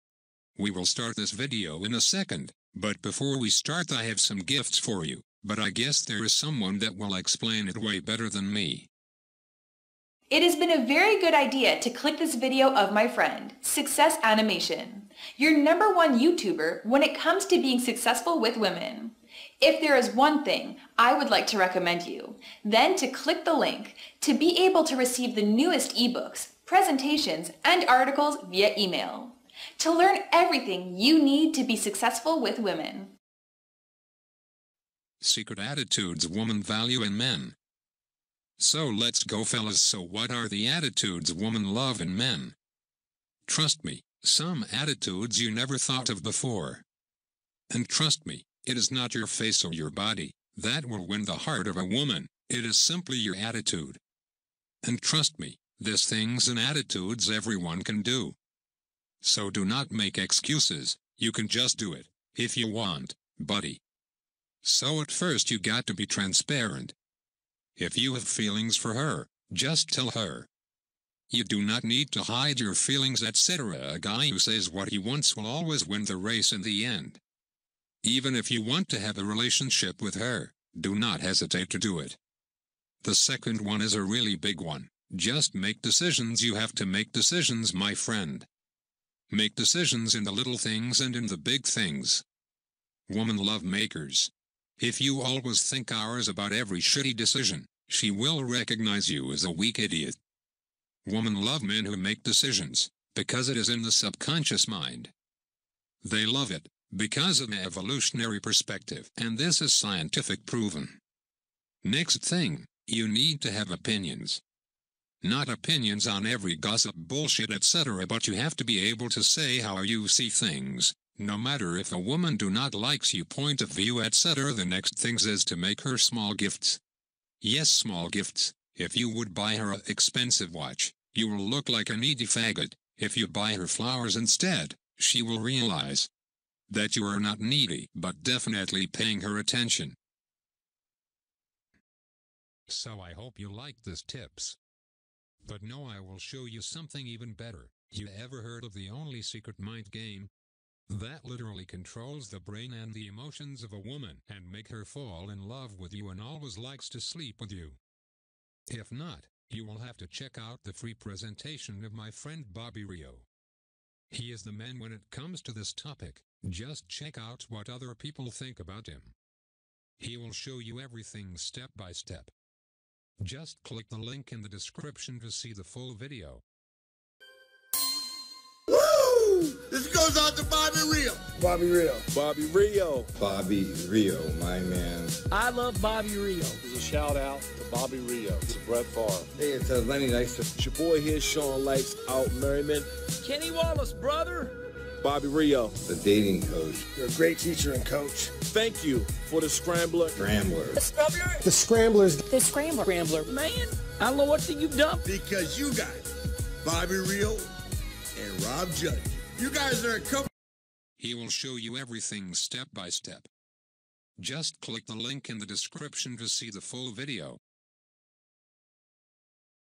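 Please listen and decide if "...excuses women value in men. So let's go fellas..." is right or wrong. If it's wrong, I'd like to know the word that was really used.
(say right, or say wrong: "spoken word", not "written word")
wrong: "attitudes", not "excuses".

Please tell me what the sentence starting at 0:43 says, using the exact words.
Trust me, some attitudes you never thought of before.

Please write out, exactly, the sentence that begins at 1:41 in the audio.
Woman love men who make decisions, because it is in the subconscious mind.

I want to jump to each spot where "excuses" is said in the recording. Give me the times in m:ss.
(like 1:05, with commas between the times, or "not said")
1:00.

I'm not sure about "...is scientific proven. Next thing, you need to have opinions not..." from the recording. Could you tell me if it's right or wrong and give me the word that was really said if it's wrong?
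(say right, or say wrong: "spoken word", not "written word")
right.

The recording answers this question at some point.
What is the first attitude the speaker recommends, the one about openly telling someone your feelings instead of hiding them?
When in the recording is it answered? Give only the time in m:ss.
1:06.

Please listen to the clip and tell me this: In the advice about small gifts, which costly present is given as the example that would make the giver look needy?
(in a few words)
Expensive watch.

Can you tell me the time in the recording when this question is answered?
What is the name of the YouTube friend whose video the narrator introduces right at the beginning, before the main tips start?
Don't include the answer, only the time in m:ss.
0:13.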